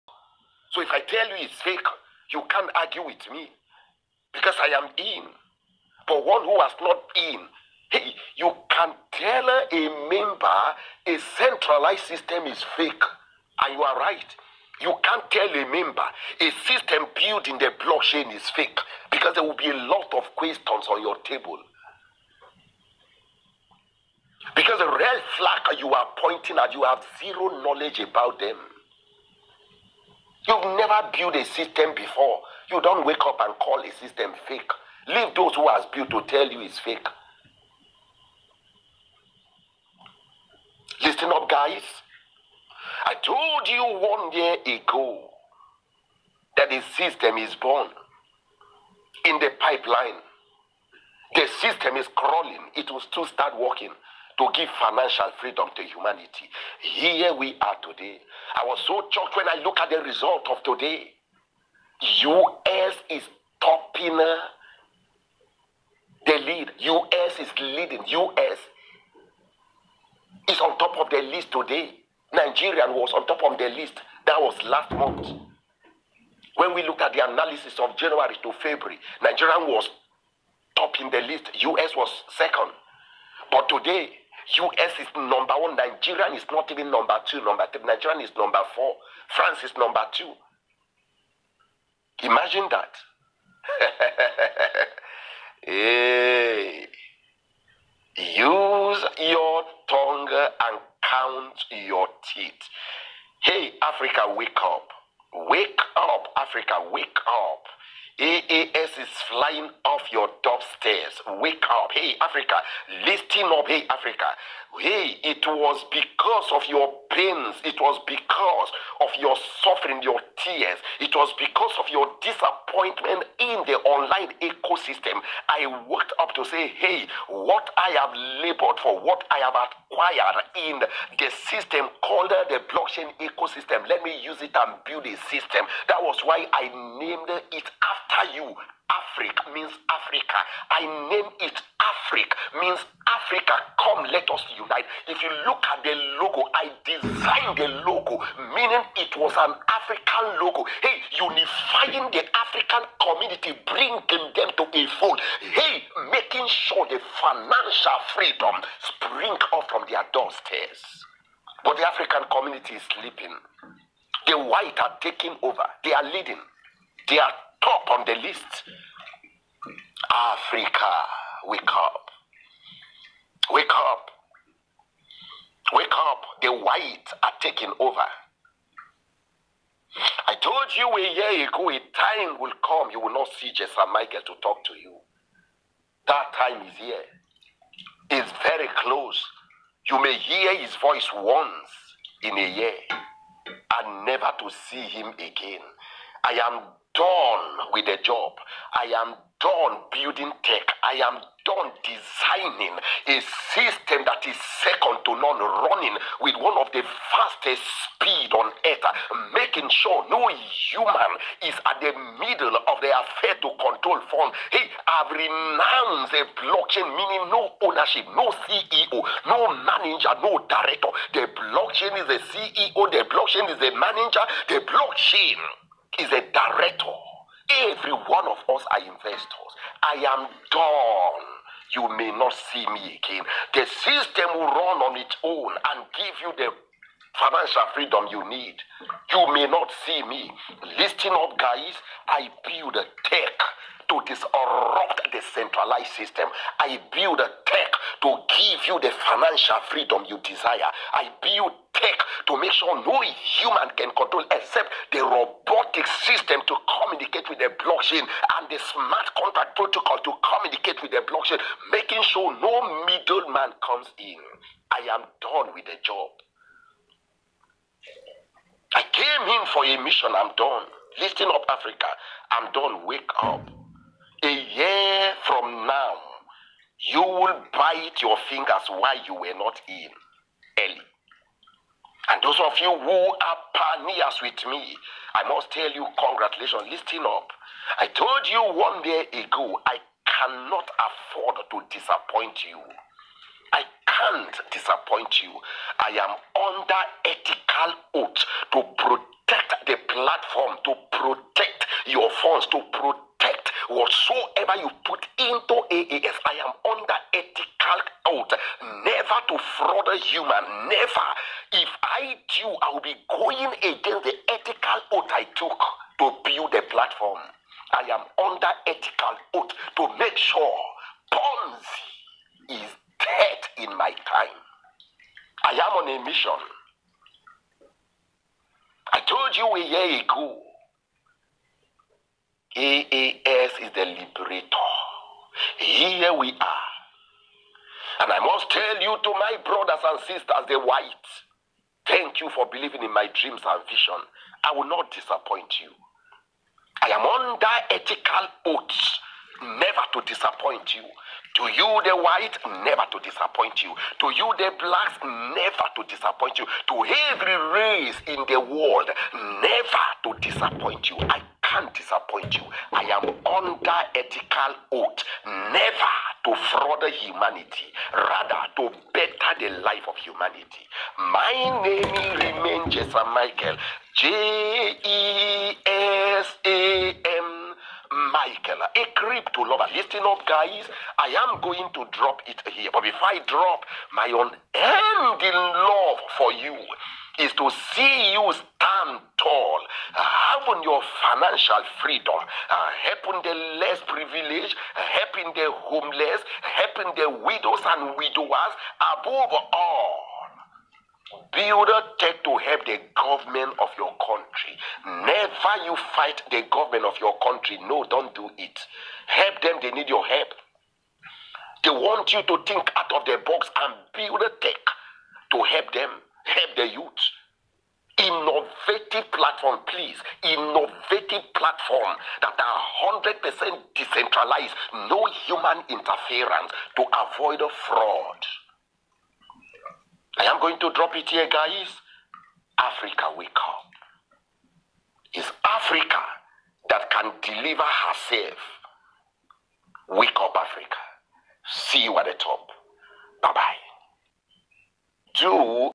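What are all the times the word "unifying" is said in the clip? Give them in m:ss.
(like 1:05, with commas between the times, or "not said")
2:31.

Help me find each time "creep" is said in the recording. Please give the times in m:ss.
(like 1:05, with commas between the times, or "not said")
6:18.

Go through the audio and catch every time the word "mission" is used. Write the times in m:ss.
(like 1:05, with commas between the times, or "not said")
4:29, 5:26.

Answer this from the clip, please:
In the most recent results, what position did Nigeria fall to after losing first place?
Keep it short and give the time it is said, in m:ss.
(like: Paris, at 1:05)
Number 4, at 1:28.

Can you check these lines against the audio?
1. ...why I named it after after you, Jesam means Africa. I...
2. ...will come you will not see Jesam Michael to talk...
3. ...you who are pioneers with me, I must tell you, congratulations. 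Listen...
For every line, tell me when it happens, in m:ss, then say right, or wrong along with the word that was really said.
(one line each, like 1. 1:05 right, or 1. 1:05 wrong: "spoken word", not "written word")
1. 2:16 wrong: "Afriq", not "Jesam"
2. 3:02 right
3. 4:42 right.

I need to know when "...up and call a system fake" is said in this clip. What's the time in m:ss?
0:33.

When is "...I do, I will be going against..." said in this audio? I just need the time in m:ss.
5:11.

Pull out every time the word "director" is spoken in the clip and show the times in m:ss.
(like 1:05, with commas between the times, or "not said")
3:40, 3:46.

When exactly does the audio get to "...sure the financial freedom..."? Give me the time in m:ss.
2:36.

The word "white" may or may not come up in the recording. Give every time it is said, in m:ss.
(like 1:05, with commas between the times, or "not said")
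2:44, 2:56, 5:40, 5:51.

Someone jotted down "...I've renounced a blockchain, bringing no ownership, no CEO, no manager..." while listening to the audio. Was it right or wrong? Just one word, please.
wrong.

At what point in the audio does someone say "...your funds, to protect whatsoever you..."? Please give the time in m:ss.
5:01.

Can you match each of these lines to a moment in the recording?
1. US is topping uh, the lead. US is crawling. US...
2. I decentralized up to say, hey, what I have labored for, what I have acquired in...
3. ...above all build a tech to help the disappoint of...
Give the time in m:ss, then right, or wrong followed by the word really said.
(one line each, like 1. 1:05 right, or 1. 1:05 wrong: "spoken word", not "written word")
1. 1:02 wrong: "leading", not "crawling"
2. 2:05 wrong: "worked", not "decentralized"
3. 6:38 wrong: "government", not "disappoint".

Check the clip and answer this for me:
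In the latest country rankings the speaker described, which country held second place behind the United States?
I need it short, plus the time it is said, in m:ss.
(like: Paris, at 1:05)
France, at 1:29.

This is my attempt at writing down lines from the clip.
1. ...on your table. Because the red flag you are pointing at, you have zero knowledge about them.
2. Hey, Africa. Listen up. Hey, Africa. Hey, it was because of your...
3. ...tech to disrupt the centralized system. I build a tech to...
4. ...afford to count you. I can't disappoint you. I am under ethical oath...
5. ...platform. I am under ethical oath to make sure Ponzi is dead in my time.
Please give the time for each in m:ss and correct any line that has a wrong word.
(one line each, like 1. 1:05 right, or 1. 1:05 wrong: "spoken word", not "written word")
1. 0:20 right
2. 1:51 right
3. 4:03 right
4. 4:50 wrong: "disappoint", not "count"
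5. 5:16 right.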